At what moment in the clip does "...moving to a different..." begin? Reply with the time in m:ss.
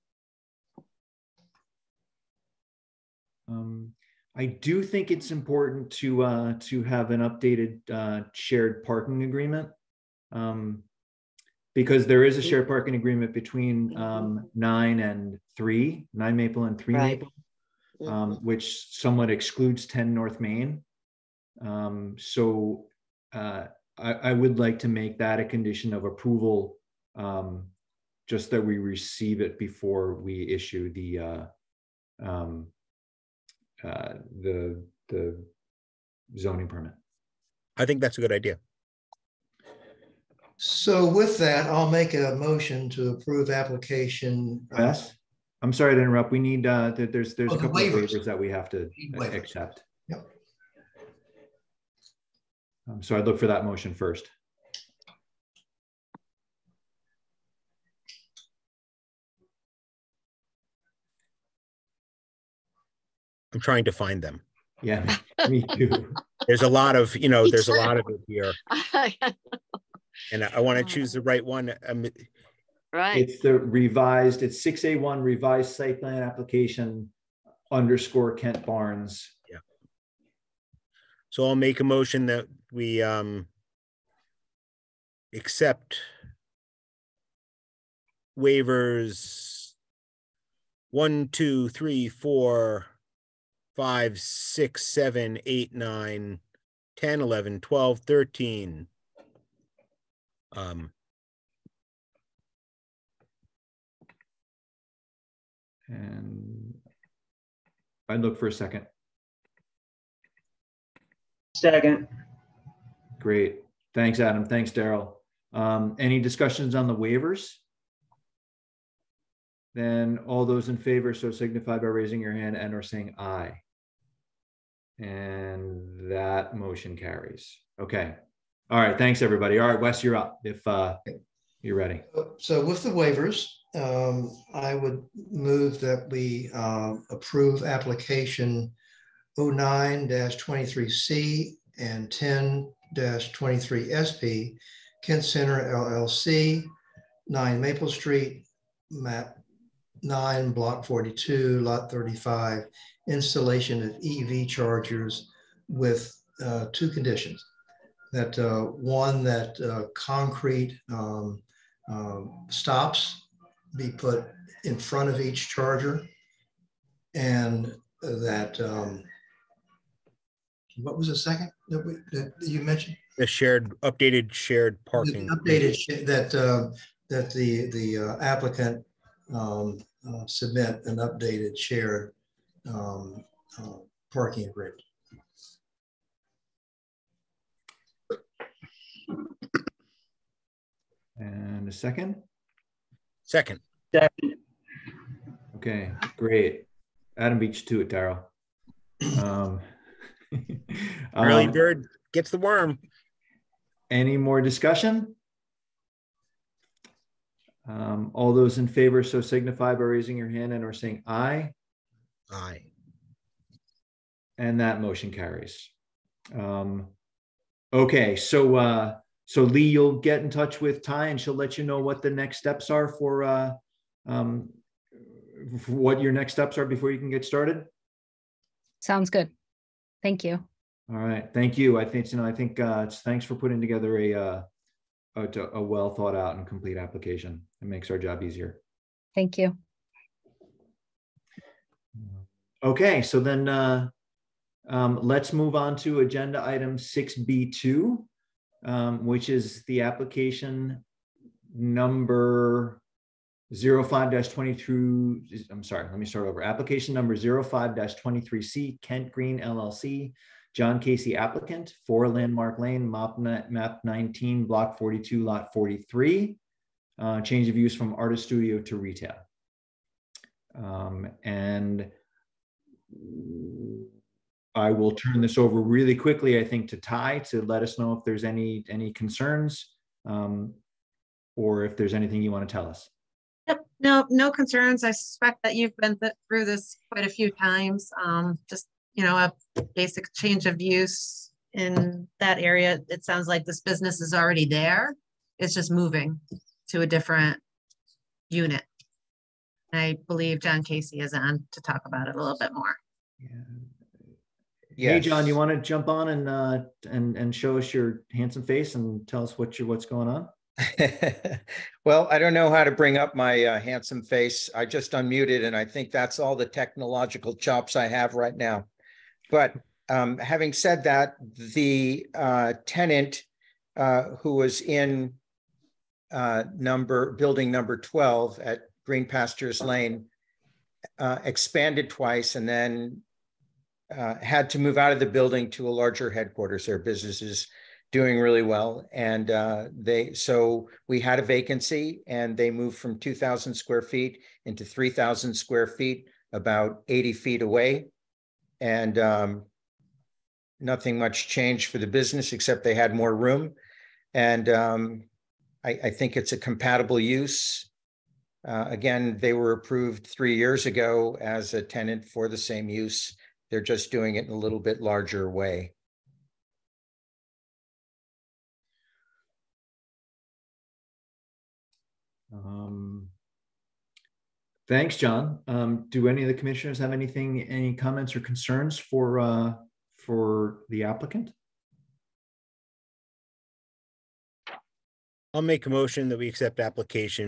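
4:55.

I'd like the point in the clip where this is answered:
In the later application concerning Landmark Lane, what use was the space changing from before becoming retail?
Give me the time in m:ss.
4:27.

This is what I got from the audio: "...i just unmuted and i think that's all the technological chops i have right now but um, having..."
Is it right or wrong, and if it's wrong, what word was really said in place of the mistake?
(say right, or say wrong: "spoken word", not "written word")
right.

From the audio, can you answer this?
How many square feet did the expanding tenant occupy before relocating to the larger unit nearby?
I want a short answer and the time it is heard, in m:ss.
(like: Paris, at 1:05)
2,000, at 5:42.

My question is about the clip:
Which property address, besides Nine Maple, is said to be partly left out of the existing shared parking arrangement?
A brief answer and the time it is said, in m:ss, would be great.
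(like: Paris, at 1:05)
10 North Main, at 0:19.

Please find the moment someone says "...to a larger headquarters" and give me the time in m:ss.
5:35.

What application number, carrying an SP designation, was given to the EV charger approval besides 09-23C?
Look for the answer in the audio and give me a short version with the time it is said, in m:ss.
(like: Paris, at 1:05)
10-23SP, at 2:22.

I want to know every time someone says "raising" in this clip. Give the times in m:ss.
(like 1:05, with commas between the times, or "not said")
2:01, 3:29.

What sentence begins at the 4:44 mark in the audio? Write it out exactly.
I suspect that you've been th through this quite a few times.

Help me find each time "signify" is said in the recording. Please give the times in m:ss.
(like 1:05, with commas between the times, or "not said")
2:01, 3:29.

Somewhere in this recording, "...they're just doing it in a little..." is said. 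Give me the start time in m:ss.
6:03.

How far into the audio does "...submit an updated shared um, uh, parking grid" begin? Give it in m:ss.
3:00.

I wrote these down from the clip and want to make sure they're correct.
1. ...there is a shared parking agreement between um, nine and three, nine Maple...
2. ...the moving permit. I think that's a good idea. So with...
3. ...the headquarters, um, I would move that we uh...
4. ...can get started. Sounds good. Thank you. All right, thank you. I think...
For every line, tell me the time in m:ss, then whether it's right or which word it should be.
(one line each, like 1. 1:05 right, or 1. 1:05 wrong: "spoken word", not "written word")
1. 0:12 right
2. 0:35 wrong: "zoning", not "moving"
3. 2:12 wrong: "waivers", not "headquarters"
4. 3:46 right.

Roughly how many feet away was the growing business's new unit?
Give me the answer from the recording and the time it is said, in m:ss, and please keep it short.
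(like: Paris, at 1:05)
80 feet, at 5:46.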